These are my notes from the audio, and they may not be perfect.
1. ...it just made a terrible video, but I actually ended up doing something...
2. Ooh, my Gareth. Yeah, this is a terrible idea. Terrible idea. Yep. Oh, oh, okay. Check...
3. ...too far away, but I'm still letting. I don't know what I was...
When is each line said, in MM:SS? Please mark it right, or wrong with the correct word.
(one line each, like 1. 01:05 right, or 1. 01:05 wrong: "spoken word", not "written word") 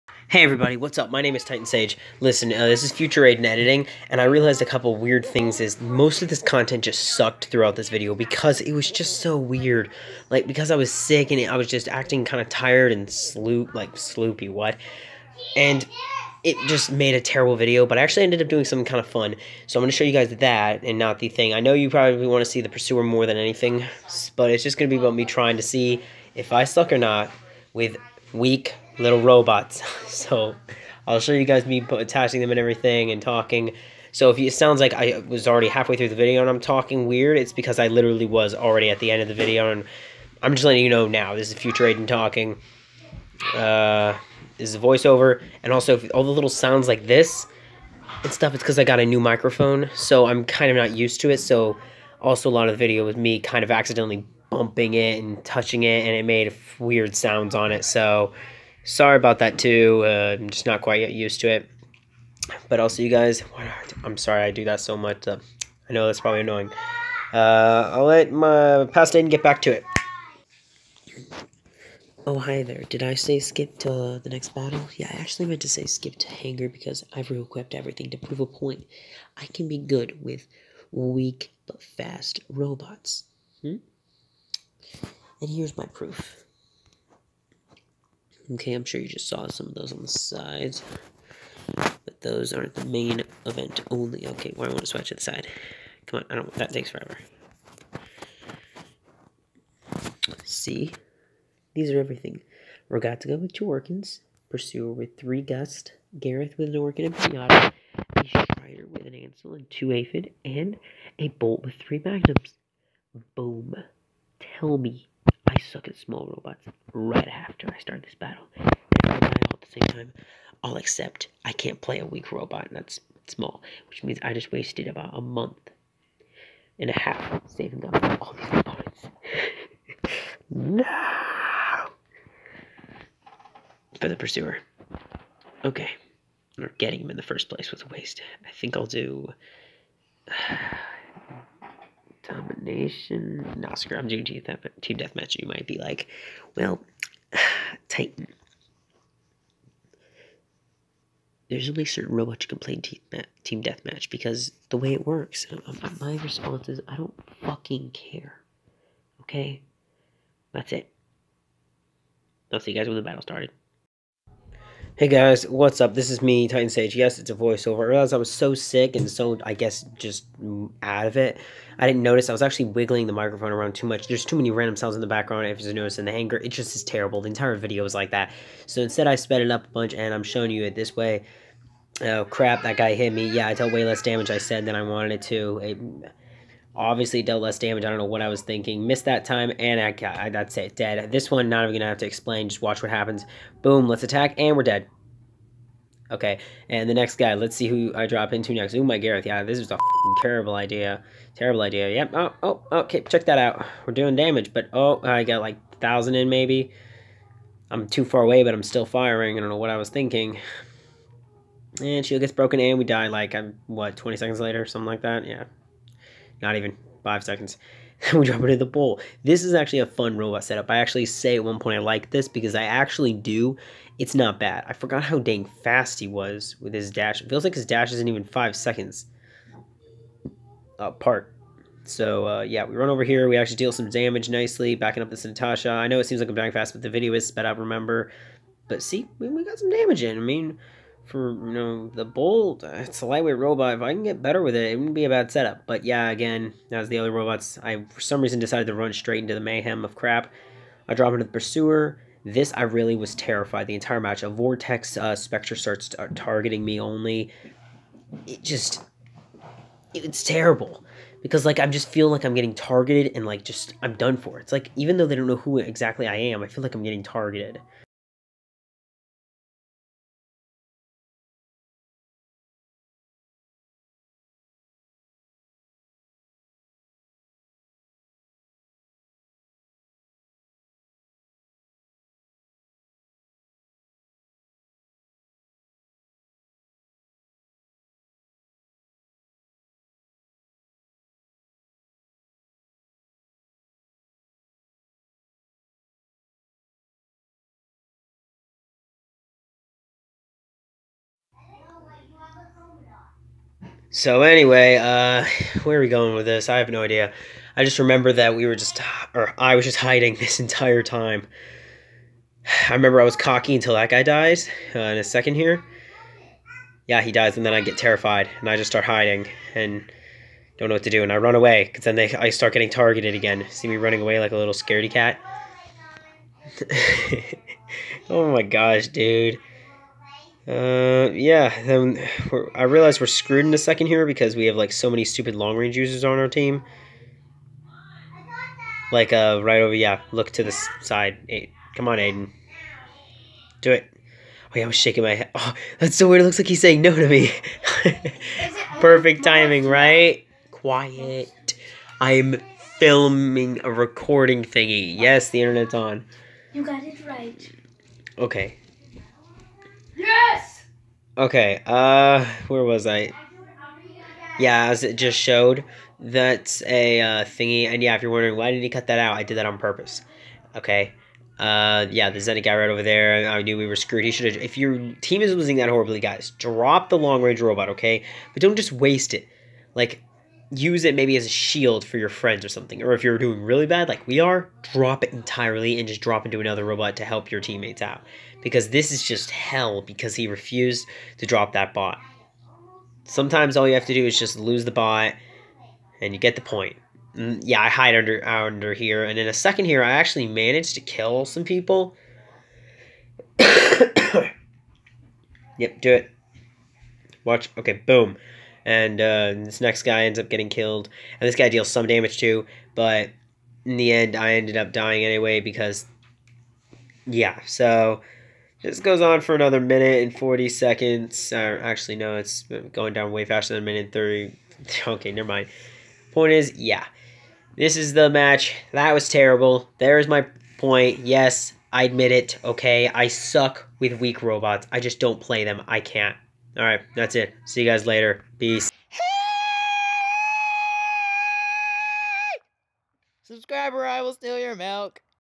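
1. 00:16 right
2. 03:18 right
3. 03:27 wrong: "firing", not "letting".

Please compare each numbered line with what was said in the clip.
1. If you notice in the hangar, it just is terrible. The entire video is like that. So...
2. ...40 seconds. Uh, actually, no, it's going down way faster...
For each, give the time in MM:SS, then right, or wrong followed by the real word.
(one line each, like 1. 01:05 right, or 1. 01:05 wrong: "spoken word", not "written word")
1. 02:55 right
2. 07:00 right.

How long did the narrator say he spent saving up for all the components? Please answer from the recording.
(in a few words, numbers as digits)
a month and a half.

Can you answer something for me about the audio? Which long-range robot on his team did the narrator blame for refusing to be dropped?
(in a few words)
Zenit.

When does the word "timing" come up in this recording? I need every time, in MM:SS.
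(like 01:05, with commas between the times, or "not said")
05:49.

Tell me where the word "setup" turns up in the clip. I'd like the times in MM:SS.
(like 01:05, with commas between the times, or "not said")
03:40, 04:05.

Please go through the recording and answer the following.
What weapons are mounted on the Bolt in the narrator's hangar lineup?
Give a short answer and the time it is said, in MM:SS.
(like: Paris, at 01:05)
three Magnums, at 01:51.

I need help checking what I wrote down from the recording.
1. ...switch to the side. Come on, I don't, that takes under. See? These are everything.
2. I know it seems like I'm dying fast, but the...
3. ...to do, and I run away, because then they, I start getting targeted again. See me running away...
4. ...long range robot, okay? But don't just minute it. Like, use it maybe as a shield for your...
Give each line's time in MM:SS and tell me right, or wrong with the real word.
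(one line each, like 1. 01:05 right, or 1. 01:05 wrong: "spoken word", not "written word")
1. 01:34 wrong: "forever", not "under"
2. 03:55 right
3. 05:20 right
4. 06:16 wrong: "waste", not "minute".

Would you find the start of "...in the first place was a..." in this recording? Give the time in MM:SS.
02:17.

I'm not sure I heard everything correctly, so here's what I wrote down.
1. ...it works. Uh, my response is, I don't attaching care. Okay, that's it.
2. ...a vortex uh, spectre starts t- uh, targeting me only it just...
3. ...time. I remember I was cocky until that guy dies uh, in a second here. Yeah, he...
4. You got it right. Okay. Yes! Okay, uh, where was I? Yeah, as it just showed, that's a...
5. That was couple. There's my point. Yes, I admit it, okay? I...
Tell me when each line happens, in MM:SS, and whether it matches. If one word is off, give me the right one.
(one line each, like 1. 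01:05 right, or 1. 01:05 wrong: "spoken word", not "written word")
1. 02:34 wrong: "fucking", not "attaching"
2. 04:14 right
3. 05:10 right
4. 05:56 right
5. 07:08 wrong: "terrible", not "couple".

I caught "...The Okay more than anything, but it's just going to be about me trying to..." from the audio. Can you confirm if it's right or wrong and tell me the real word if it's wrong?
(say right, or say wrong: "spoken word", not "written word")
wrong: "Pursuer", not "Okay".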